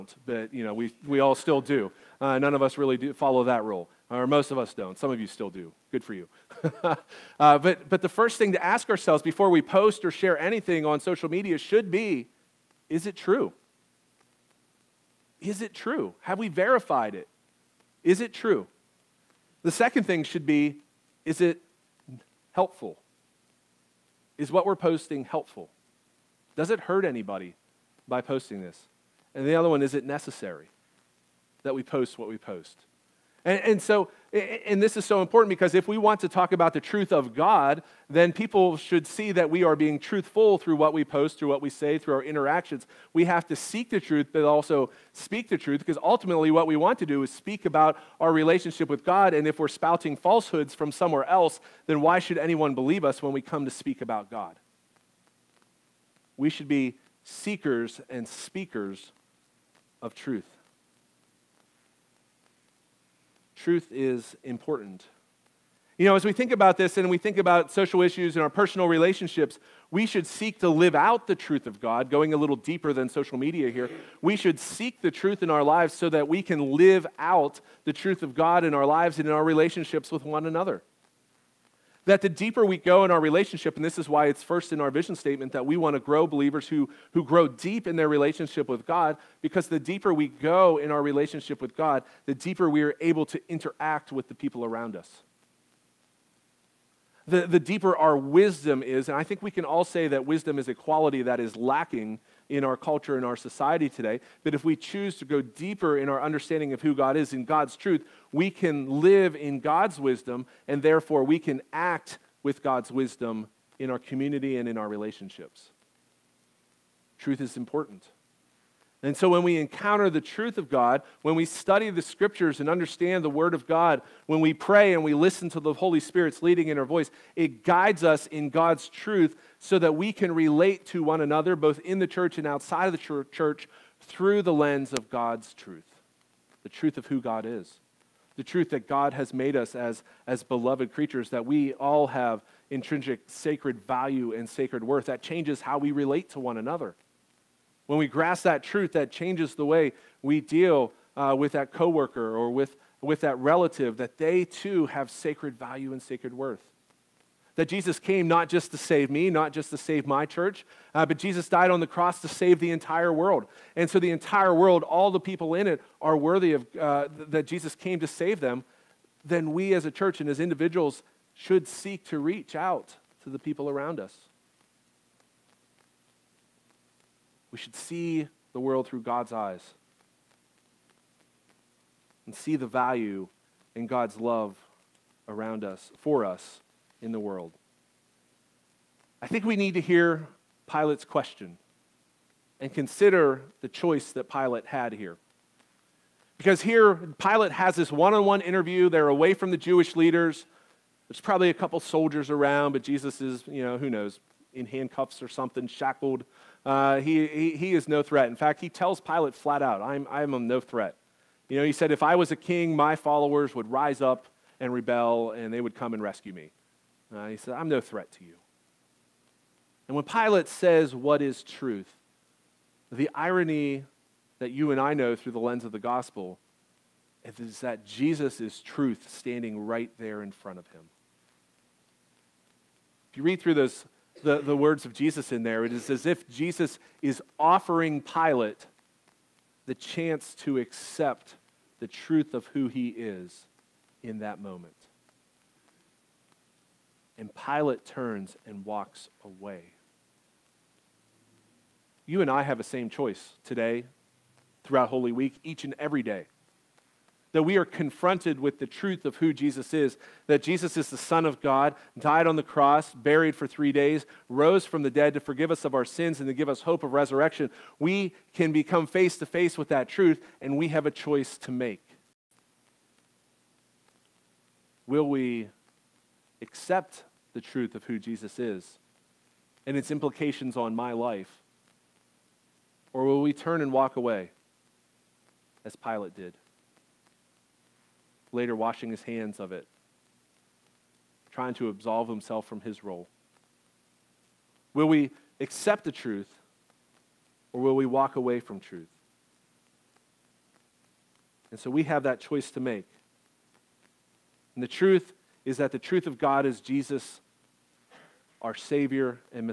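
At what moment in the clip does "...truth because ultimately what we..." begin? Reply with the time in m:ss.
0:45.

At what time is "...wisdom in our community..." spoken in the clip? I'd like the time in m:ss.
1:52.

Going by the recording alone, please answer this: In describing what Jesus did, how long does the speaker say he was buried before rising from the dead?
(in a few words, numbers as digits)
3 days.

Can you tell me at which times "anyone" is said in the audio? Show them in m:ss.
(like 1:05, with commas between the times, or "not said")
0:52.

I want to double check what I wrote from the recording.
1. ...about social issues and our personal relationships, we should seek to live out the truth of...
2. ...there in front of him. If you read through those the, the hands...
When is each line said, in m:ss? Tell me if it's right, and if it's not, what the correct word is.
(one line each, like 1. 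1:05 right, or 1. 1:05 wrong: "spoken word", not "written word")
1. 1:07 right
2. 3:49 wrong: "words", not "hands".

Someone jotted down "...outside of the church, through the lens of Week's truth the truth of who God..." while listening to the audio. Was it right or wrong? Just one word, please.
wrong.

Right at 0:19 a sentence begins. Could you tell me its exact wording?
The second thing should be is it helpful?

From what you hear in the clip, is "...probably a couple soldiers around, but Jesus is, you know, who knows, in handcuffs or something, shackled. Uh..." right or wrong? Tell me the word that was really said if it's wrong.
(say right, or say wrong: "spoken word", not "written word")
right.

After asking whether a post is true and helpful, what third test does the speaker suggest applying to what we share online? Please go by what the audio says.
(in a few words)
Is it necessary.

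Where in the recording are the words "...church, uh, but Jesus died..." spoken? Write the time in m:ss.
2:40.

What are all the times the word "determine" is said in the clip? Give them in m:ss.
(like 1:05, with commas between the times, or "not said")
not said.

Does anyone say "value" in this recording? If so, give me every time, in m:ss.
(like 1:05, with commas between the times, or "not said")
2:23, 2:35, 3:02.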